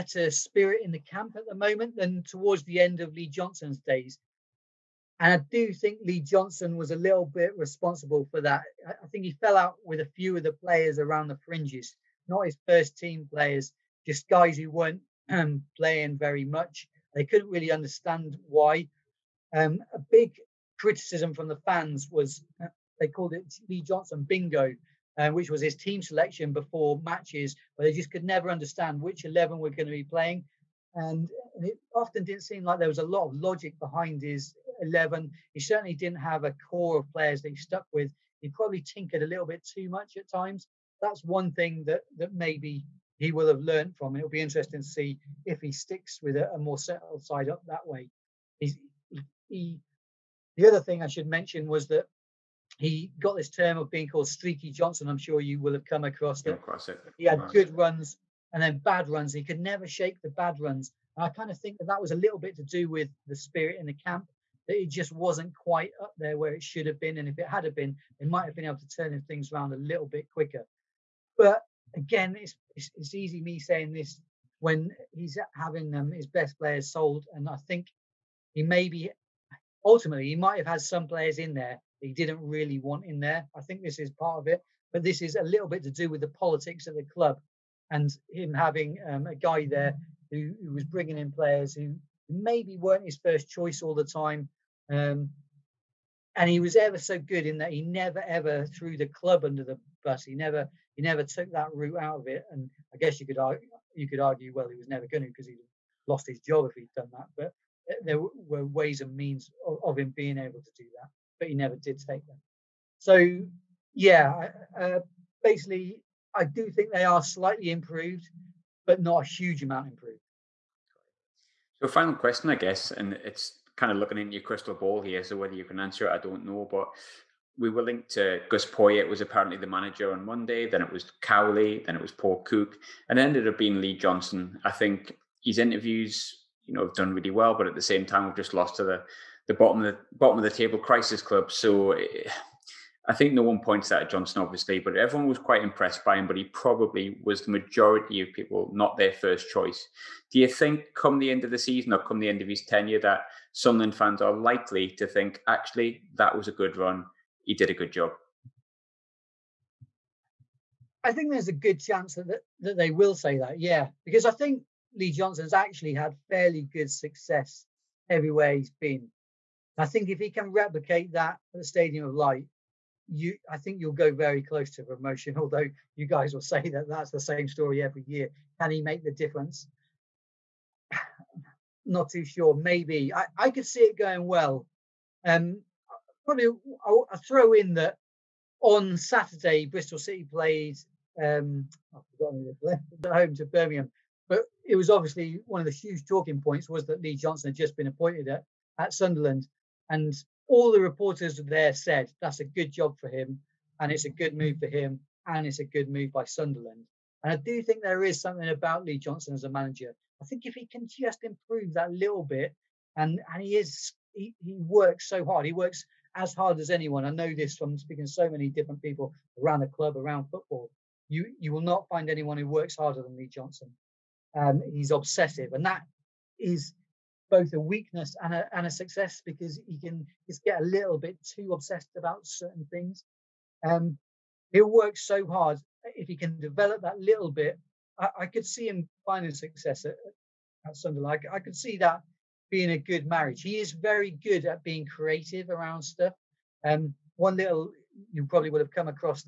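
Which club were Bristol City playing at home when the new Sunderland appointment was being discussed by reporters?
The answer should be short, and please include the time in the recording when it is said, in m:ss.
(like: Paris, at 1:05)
Birmingham, at 3:13.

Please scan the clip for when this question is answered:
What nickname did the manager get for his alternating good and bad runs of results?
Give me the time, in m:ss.
0:54.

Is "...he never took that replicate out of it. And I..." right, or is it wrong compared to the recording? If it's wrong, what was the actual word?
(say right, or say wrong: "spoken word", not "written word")
wrong: "route", not "replicate".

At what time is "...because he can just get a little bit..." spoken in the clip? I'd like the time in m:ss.
3:49.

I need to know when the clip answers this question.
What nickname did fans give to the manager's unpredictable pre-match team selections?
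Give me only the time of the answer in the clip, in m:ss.
0:23.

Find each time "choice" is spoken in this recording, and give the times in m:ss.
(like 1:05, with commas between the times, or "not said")
1:33, 2:29.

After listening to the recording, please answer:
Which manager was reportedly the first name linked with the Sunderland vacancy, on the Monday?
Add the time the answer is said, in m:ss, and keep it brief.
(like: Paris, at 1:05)
Gus Poyet, at 2:08.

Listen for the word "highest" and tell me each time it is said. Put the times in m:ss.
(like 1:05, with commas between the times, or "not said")
not said.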